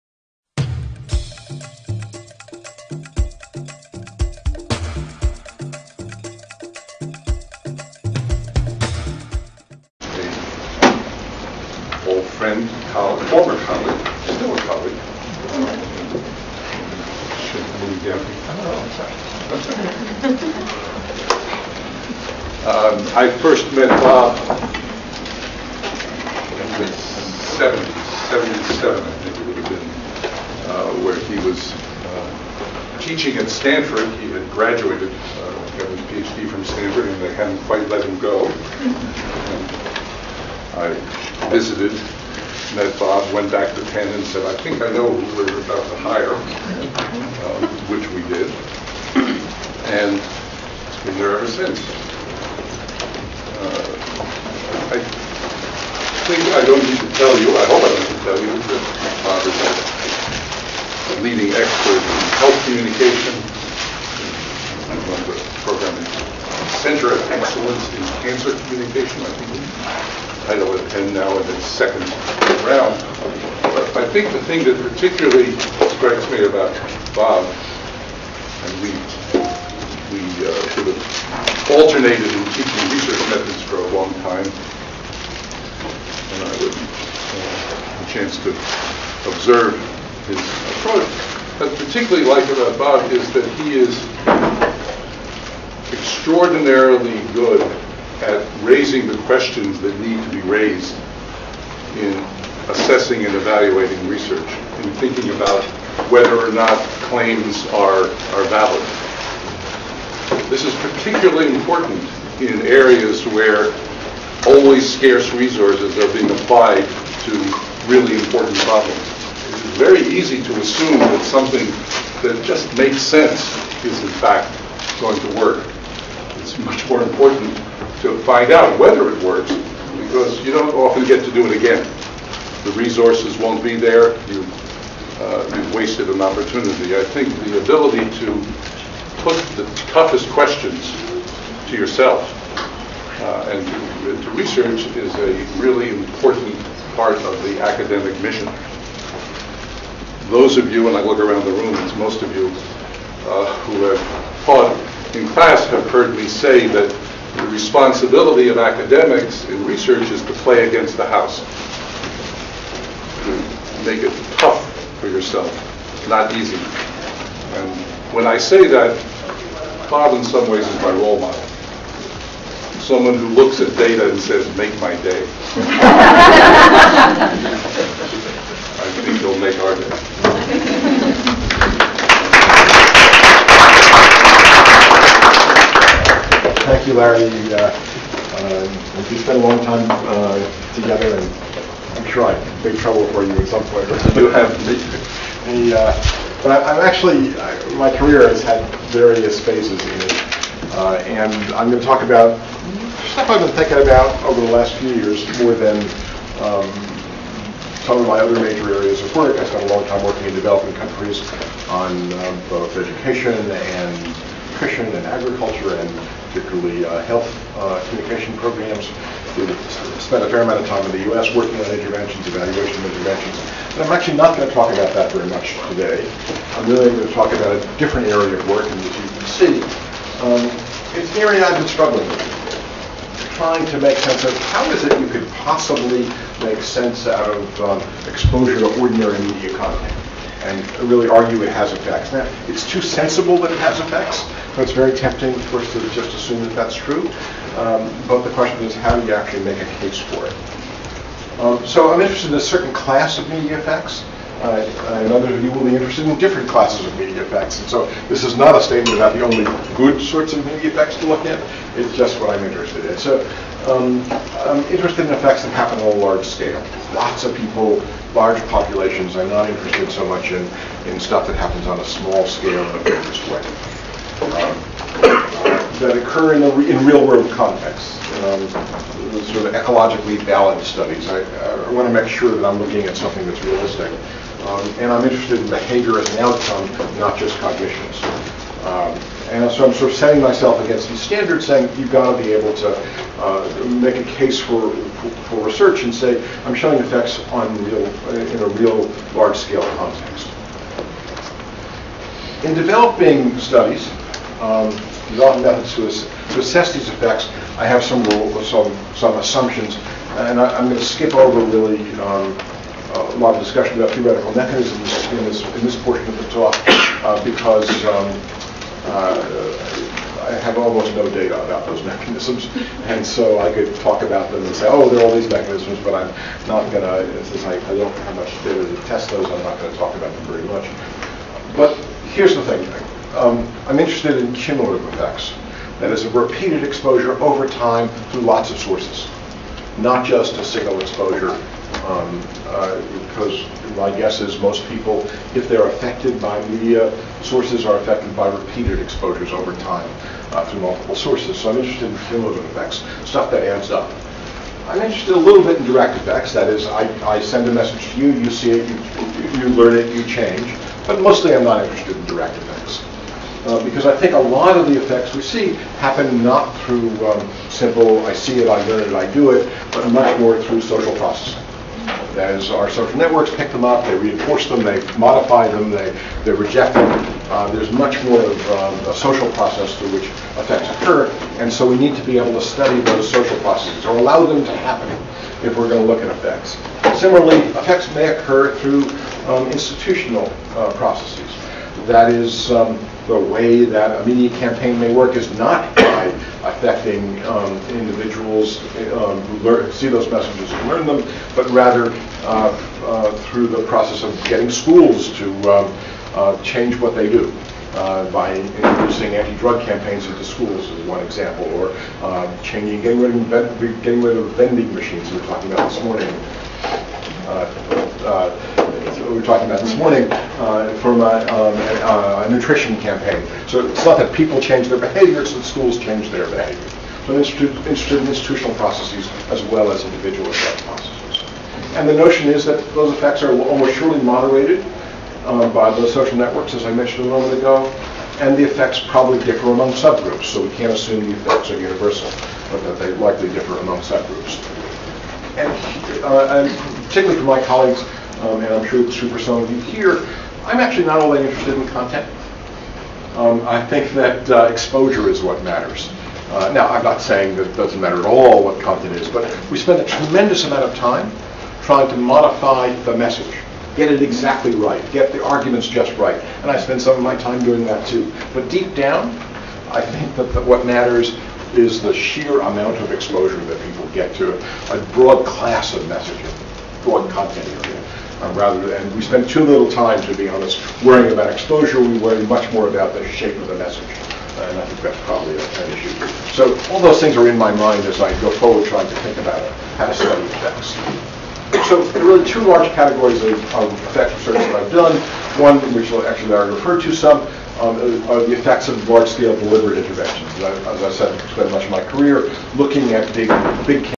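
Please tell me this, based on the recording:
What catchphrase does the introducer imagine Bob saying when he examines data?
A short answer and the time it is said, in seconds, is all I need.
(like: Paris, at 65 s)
make my day, at 174 s.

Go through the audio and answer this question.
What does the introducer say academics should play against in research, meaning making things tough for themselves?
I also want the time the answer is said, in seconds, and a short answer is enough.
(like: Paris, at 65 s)
the house, at 160 s.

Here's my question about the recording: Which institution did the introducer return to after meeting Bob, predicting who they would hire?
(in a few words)
Penn.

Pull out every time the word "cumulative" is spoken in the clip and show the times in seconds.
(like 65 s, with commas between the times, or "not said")
334 s, 352 s.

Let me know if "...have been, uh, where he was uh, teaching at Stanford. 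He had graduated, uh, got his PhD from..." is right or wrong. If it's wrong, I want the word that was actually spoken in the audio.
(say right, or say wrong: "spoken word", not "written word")
right.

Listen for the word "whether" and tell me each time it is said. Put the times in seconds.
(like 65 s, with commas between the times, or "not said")
106 s, 128 s.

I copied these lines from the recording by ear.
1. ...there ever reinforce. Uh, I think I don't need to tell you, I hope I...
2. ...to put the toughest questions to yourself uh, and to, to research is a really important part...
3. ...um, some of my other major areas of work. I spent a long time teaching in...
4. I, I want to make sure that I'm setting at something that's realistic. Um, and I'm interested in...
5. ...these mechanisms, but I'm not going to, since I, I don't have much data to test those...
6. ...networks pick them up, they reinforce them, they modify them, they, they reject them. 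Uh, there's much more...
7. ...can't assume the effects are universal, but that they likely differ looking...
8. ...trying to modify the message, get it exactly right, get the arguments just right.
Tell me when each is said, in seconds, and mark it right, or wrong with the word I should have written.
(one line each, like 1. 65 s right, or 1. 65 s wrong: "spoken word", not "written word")
1. 51 s wrong: "since", not "reinforce"
2. 138 s right
3. 206 s wrong: "working", not "teaching"
4. 281 s wrong: "looking", not "setting"
5. 325 s right
6. 372 s right
7. 440 s wrong: "among", not "looking"
8. 461 s right.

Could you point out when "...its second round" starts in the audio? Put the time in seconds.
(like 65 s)
71 s.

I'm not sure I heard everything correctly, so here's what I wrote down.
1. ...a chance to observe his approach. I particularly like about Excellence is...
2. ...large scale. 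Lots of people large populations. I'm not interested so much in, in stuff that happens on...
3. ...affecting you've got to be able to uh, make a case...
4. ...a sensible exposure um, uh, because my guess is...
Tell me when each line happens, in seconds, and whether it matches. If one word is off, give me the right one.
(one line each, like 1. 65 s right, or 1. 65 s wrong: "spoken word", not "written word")
1. 88 s wrong: "Bob", not "Excellence"
2. 265 s right
3. 291 s wrong: "saying", not "affecting"
4. 340 s wrong: "single", not "sensible".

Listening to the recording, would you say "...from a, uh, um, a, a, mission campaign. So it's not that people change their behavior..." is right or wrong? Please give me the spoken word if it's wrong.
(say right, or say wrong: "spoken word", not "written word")
wrong: "nutrition", not "mission".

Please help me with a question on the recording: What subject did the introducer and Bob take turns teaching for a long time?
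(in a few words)
research methods.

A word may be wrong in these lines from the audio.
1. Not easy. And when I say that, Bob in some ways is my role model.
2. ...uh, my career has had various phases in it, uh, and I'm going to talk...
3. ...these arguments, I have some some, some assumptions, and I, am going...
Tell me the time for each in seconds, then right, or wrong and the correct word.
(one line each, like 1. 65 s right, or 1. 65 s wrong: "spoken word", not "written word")
1. 166 s right
2. 197 s right
3. 306 s wrong: "effects", not "arguments".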